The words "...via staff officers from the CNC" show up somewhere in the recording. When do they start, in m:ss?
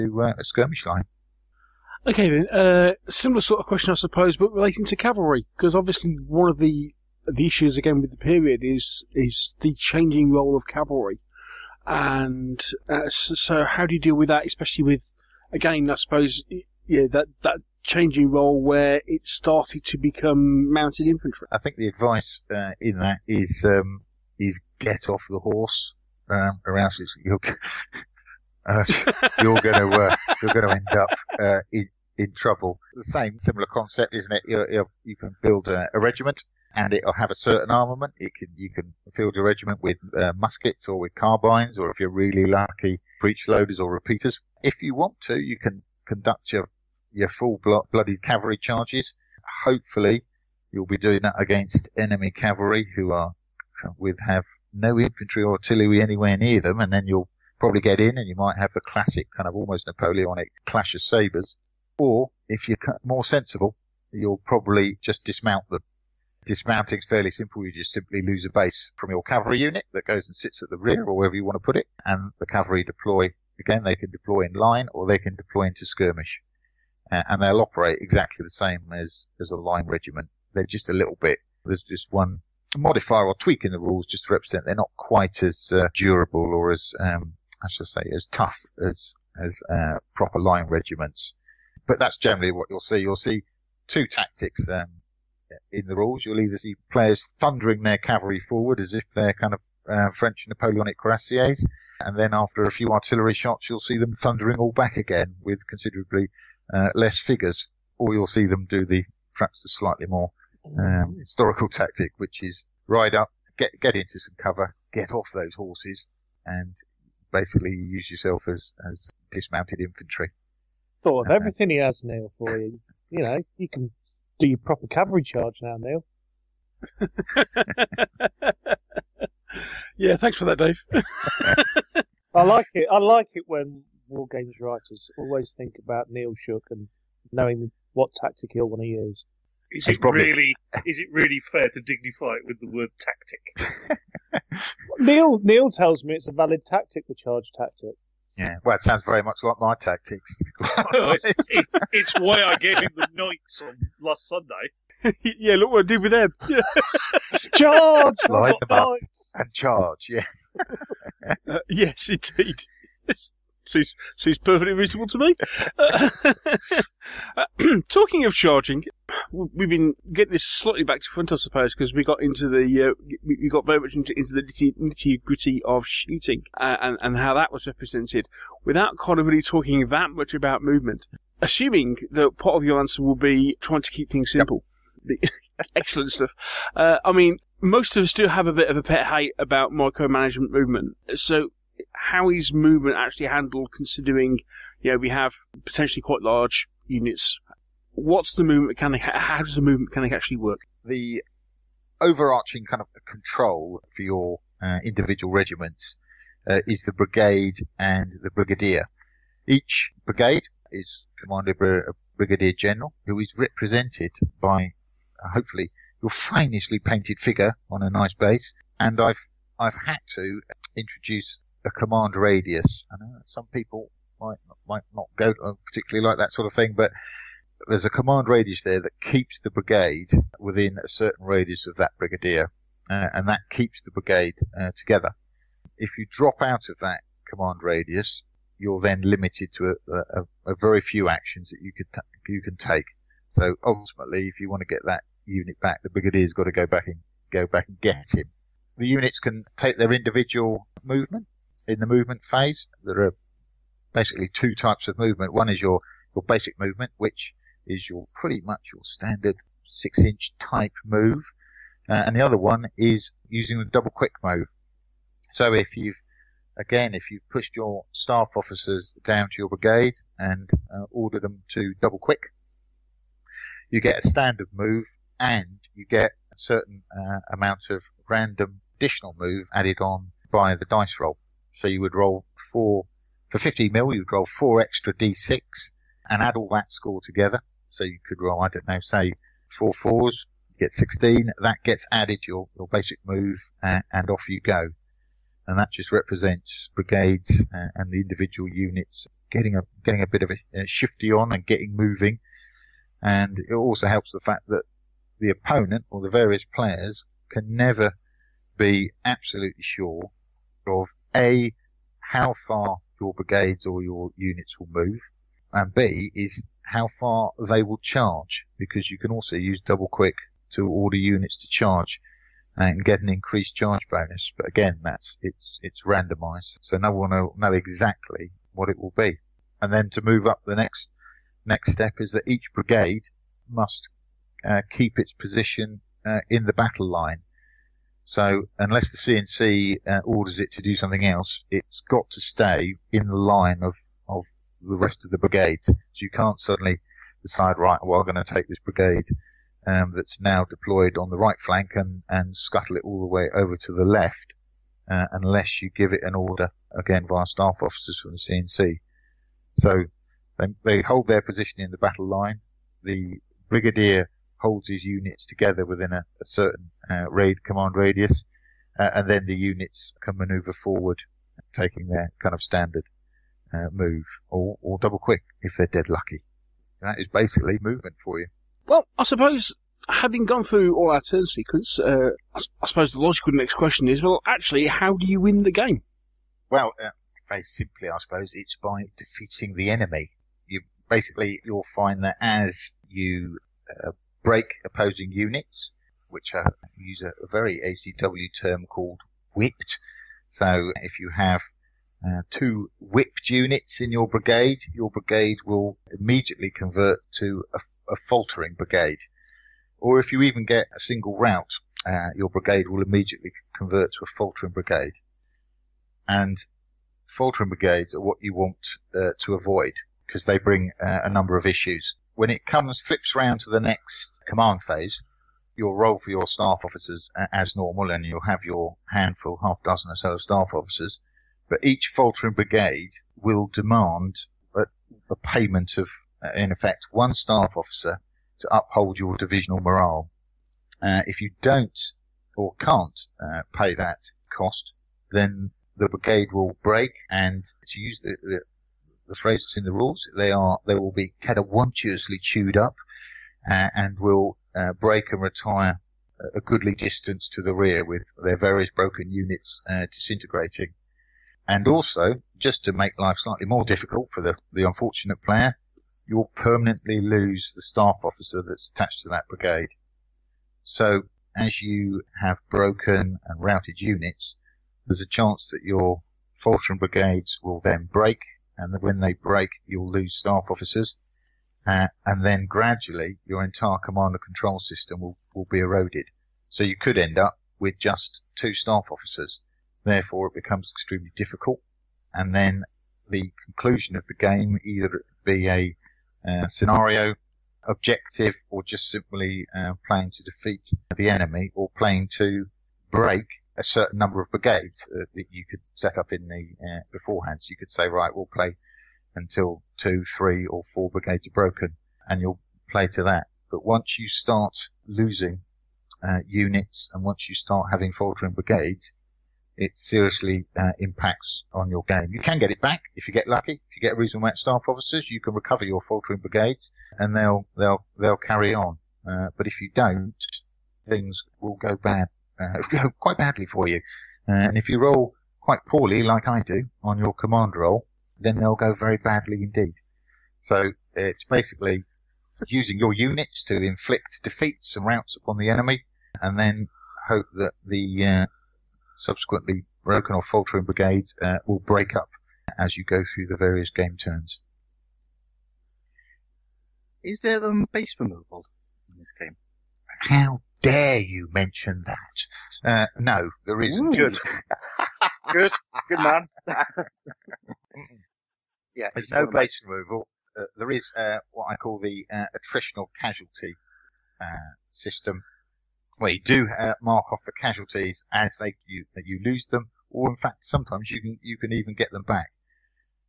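5:57.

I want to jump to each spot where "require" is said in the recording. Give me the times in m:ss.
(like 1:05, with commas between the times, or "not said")
not said.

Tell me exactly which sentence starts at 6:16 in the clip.
That is basically movement for you.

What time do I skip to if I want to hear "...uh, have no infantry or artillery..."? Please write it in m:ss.
0:54.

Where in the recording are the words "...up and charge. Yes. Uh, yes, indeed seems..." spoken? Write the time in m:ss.
2:38.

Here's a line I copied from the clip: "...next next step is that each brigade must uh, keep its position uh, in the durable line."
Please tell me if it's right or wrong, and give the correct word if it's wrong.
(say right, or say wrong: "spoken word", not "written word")
wrong: "battle", not "durable".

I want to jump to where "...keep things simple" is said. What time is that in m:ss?
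3:03.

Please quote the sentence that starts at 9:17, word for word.
Is there um, base removal in this game?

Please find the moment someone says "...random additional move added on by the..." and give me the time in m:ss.
4:38.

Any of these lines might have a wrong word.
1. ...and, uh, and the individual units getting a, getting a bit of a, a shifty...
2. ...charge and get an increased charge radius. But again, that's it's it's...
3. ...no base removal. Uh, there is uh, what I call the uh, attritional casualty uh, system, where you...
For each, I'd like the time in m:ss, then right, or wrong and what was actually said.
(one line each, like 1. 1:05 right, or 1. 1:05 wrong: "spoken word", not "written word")
1. 4:57 right
2. 5:21 wrong: "bonus", not "radius"
3. 9:29 right.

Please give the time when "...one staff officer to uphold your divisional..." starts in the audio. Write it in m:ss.
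7:16.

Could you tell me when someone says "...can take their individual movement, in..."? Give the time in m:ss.
4:09.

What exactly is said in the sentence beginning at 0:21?
I think the advice uh, in that is um, is get off the horse.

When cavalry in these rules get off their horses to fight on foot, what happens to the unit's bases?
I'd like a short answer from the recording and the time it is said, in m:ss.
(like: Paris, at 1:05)
Lose a base, at 1:08.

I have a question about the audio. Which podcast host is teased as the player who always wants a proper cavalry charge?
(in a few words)
Neil Shuck.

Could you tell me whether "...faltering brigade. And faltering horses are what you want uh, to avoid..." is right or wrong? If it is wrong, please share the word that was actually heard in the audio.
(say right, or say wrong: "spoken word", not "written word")
wrong: "brigades", not "horses".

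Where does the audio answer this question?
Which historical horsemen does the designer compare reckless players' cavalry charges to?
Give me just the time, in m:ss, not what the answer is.
1:40.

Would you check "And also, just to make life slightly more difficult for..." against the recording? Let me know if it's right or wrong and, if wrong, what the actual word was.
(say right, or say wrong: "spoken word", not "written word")
right.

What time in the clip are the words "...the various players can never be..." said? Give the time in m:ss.
5:06.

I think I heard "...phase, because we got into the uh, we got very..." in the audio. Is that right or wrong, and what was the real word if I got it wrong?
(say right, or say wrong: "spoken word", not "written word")
wrong: "suppose", not "phase".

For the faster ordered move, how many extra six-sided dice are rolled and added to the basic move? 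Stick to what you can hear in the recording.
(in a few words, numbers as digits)
4.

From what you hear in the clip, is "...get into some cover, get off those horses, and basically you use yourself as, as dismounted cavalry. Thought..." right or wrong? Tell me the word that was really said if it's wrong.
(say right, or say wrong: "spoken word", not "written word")
wrong: "infantry", not "cavalry".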